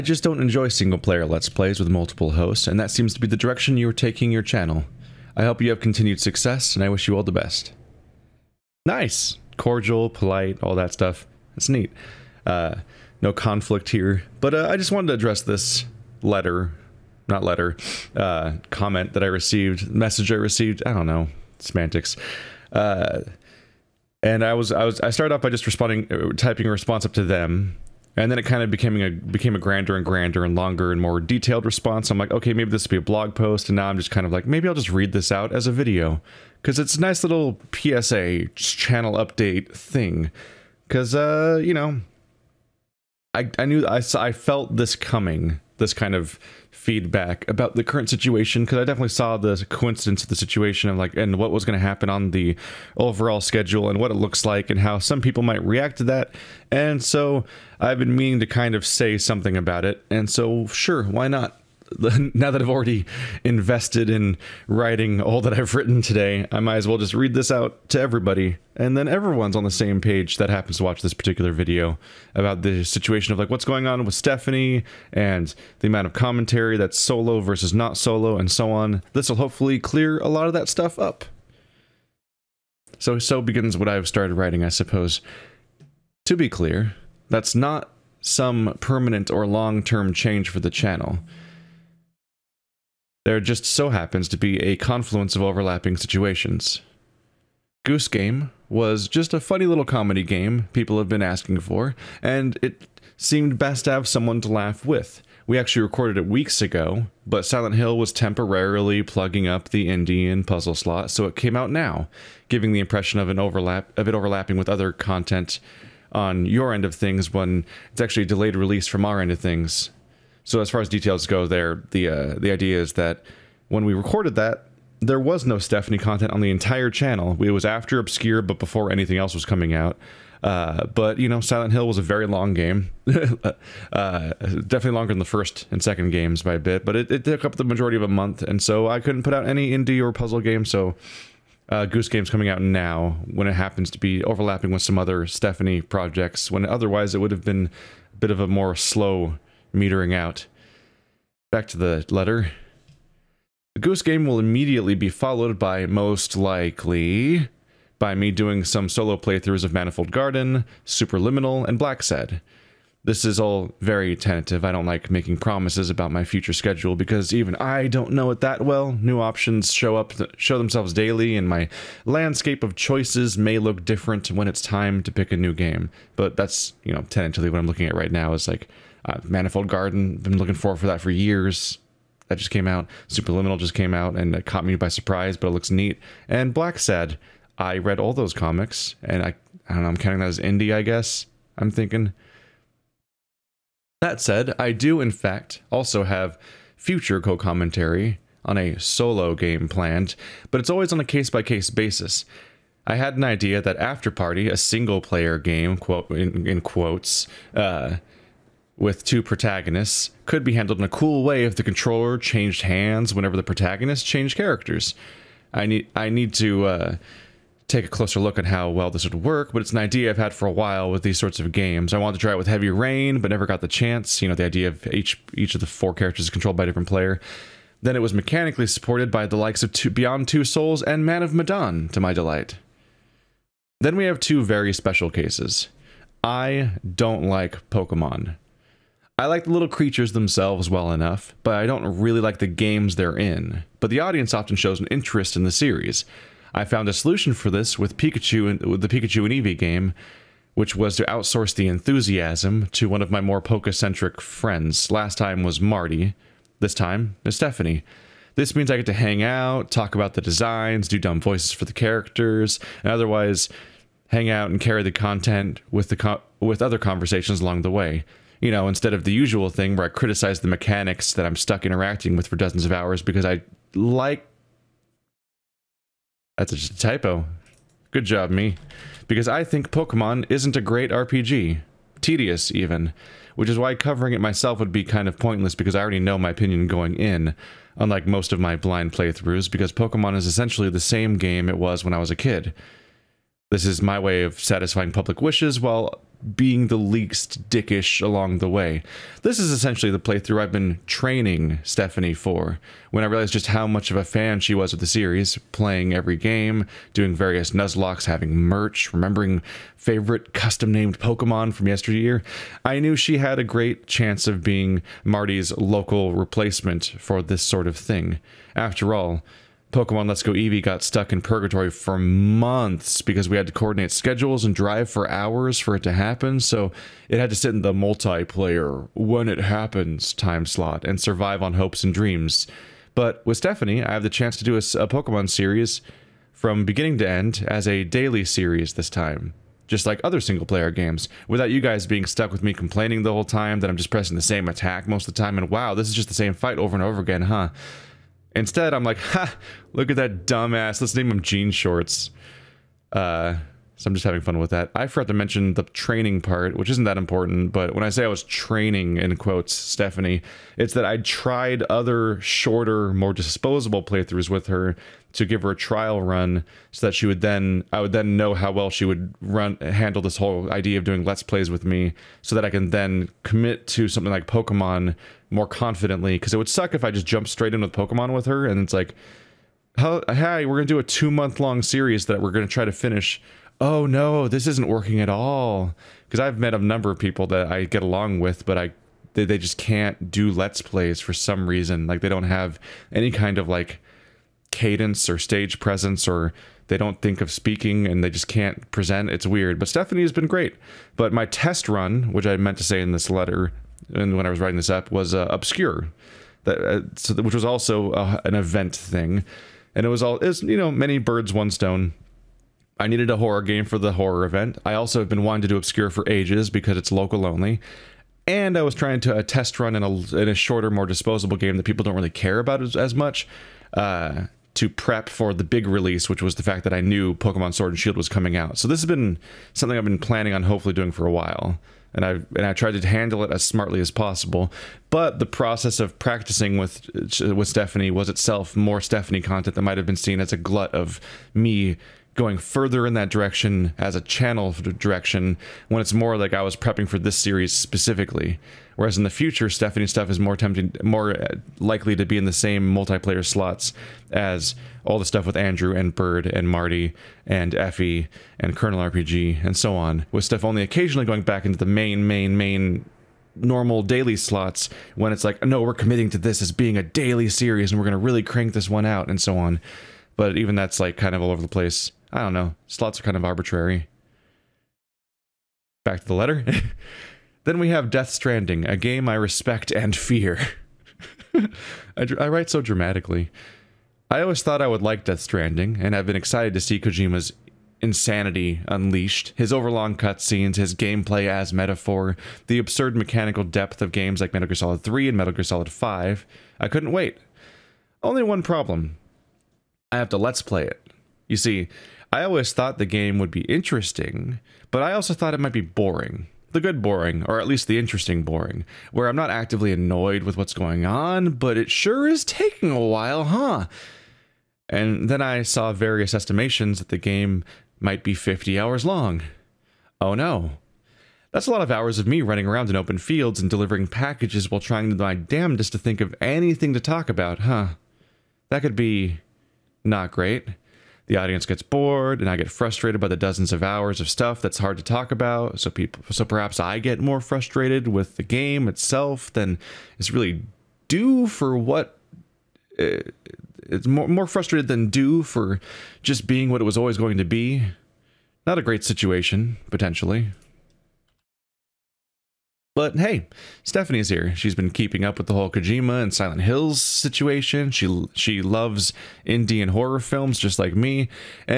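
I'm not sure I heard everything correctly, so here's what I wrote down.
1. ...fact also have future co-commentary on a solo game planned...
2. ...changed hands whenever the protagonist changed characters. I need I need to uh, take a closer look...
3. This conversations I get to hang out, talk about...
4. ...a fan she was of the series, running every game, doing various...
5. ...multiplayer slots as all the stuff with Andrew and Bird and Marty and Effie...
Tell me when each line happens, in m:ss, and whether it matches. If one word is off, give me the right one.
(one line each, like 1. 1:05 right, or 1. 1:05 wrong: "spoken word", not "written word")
1. 3:15 right
2. 3:32 right
3. 4:18 wrong: "means", not "conversations"
4. 5:03 wrong: "playing", not "running"
5. 7:32 right.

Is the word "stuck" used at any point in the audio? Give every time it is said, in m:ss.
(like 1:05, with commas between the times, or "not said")
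4:31, 5:20, 5:42.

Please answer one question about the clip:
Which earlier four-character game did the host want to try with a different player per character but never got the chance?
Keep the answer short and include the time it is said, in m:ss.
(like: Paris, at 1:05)
Heavy Rain, at 3:42.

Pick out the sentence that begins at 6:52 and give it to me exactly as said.
I needed a horror game for the horror event.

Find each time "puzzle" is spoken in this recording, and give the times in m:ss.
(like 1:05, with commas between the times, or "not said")
1:50, 2:20.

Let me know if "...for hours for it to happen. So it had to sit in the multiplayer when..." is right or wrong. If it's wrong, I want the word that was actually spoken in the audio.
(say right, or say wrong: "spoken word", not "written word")
right.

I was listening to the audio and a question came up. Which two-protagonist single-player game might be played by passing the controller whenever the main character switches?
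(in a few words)
After Party.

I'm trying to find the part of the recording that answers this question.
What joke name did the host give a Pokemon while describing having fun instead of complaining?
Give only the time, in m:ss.
5:51.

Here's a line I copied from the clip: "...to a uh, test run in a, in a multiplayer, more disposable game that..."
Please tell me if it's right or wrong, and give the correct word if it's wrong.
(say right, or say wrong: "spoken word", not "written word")
wrong: "shorter", not "multiplayer".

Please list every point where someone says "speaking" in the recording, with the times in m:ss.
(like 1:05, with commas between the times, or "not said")
6:37.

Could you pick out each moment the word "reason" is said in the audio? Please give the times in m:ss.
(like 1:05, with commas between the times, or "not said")
6:31.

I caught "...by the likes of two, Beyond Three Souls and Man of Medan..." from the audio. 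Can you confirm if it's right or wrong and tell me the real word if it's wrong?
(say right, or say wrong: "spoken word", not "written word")
wrong: "Two", not "Three".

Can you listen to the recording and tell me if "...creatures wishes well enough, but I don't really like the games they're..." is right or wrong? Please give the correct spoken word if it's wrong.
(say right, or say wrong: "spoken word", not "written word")
wrong: "themselves", not "wishes".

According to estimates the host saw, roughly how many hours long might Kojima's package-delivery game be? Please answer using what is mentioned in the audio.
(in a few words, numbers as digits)
50.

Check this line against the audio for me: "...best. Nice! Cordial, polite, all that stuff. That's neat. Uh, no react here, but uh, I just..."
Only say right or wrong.
wrong.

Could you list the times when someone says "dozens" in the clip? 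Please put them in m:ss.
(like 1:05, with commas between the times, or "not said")
4:32, 8:53.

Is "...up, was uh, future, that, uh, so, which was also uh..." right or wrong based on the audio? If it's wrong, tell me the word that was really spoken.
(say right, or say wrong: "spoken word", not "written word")
wrong: "obscure", not "future".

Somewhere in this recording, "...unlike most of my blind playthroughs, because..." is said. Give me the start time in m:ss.
4:47.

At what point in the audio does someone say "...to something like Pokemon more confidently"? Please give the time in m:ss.
6:13.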